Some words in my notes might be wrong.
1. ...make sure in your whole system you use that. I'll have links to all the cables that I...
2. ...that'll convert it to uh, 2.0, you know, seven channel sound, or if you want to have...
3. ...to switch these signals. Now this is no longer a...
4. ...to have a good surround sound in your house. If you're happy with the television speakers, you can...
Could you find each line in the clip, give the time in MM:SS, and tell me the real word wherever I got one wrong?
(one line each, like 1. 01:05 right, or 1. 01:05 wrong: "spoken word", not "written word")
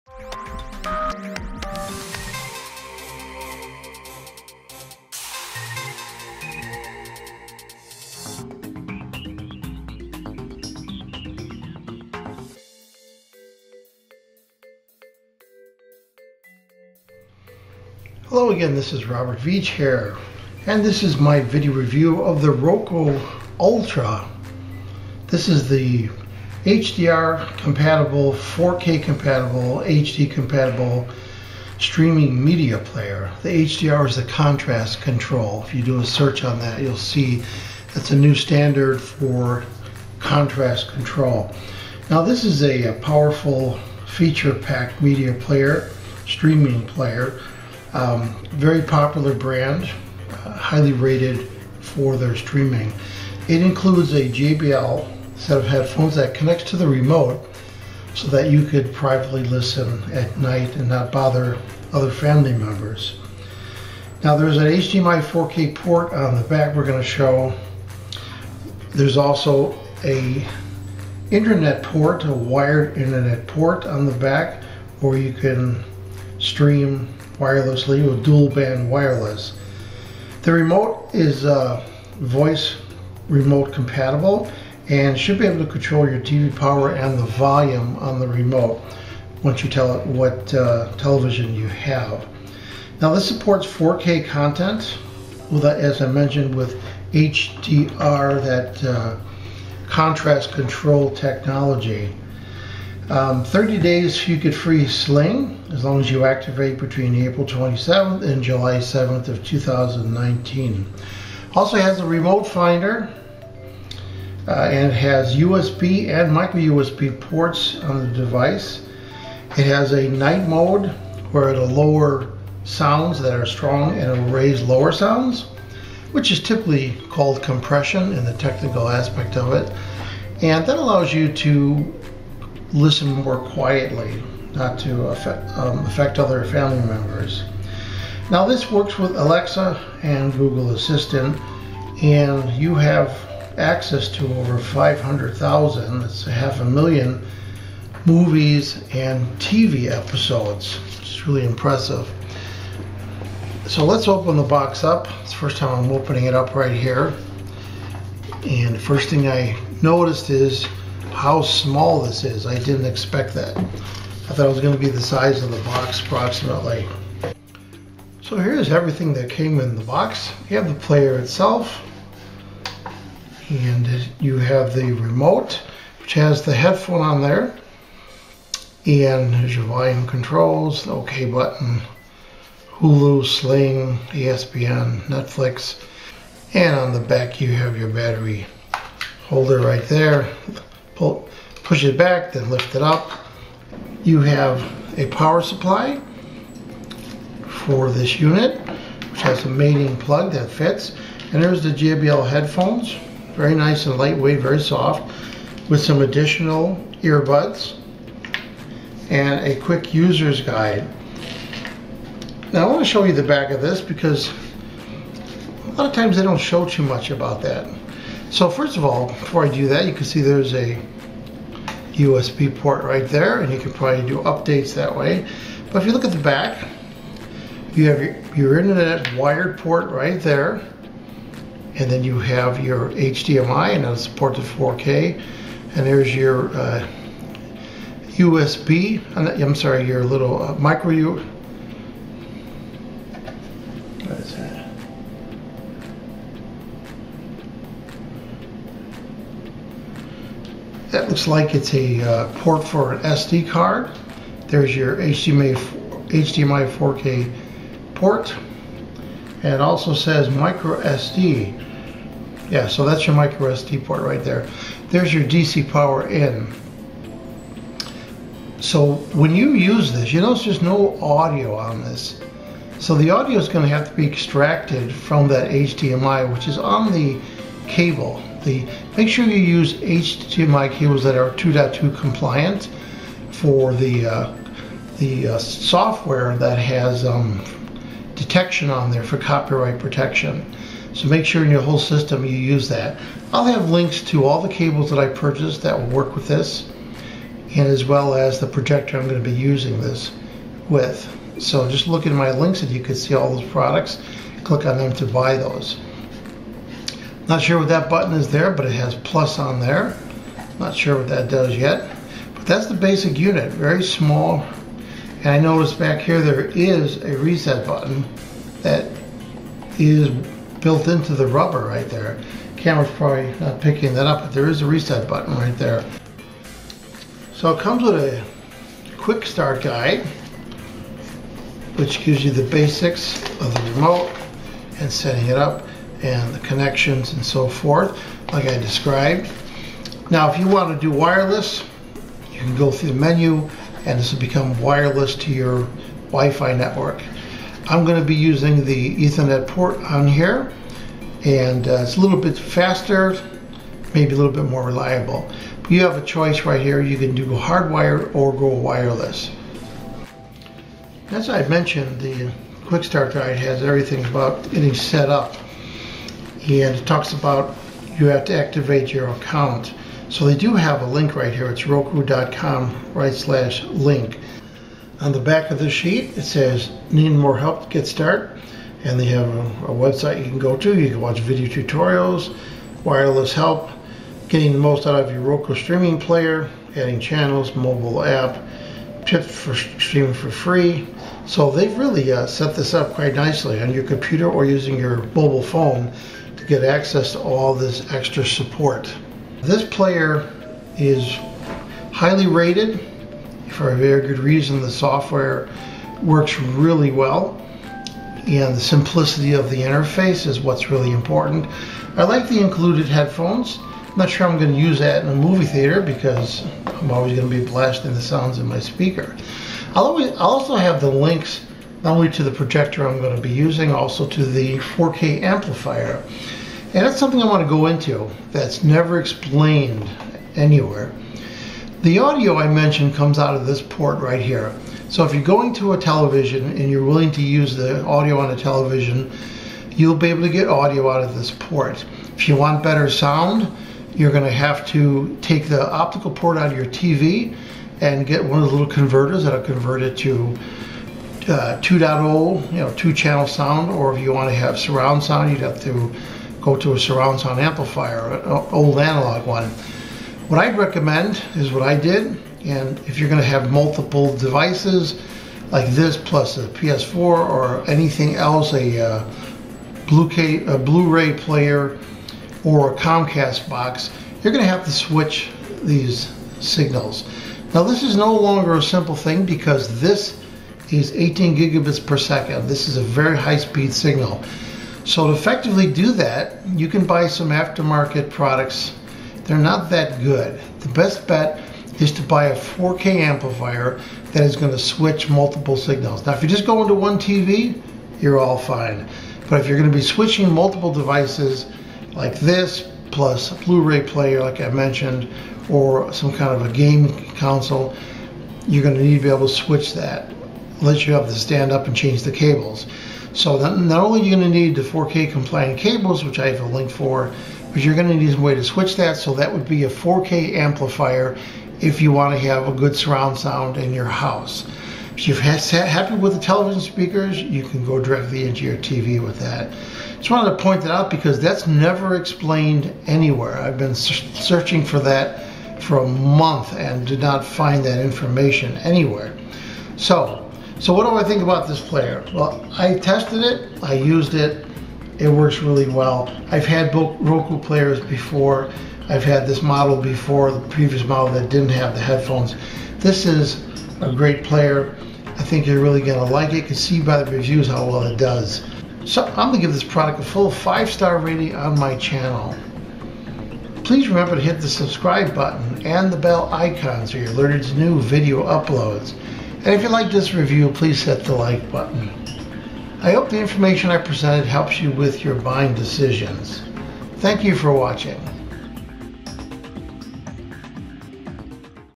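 1. 04:51 right
2. 07:29 wrong: "two", not "seven"
3. 07:54 right
4. 08:42 right.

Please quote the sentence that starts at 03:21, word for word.
And there's the JBL headphones, very nice and lightweight, very soft, with some additional earbuds and a quick user's guide.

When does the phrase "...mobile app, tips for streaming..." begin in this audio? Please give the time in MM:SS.
06:27.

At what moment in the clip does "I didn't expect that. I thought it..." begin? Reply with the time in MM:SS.
02:42.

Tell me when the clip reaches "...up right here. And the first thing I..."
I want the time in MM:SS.
02:36.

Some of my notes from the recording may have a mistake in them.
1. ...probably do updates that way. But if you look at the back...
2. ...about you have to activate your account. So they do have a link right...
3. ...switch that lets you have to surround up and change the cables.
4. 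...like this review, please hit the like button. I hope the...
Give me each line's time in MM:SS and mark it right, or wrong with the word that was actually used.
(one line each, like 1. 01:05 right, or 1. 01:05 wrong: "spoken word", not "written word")
1. 03:43 right
2. 06:07 right
3. 08:29 wrong: "stand", not "surround"
4. 09:29 right.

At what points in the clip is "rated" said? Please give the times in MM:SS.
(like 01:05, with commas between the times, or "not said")
00:50, 06:42.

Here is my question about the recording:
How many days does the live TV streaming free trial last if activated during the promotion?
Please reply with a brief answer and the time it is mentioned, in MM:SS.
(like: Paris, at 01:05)
30, at 01:43.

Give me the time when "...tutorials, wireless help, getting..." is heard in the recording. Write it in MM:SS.
06:21.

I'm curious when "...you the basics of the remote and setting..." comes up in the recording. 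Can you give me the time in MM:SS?
05:32.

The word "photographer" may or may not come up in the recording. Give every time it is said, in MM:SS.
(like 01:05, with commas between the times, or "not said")
not said.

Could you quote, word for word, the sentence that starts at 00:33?
The HDR is the contrast control.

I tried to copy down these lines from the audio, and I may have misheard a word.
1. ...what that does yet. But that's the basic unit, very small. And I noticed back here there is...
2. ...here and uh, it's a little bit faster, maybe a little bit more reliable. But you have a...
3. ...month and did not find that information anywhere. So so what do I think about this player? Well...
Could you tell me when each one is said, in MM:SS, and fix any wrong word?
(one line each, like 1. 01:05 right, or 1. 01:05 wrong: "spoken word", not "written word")
1. 05:10 right
2. 05:50 right
3. 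08:55 right.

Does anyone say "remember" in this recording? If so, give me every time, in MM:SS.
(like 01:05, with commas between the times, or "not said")
09:23.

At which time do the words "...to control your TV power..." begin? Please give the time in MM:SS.
01:25.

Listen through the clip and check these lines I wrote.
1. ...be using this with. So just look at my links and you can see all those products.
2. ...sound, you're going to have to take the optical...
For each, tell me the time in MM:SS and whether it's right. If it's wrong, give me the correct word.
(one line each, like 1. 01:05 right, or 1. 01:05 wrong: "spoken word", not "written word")
1. 04:59 right
2. 07:22 right.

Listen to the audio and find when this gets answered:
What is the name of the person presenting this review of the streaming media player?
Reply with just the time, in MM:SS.
00:19.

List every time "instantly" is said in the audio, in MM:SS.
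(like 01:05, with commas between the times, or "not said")
not said.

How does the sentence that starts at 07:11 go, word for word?
The audio I mentioned comes out of this port right here.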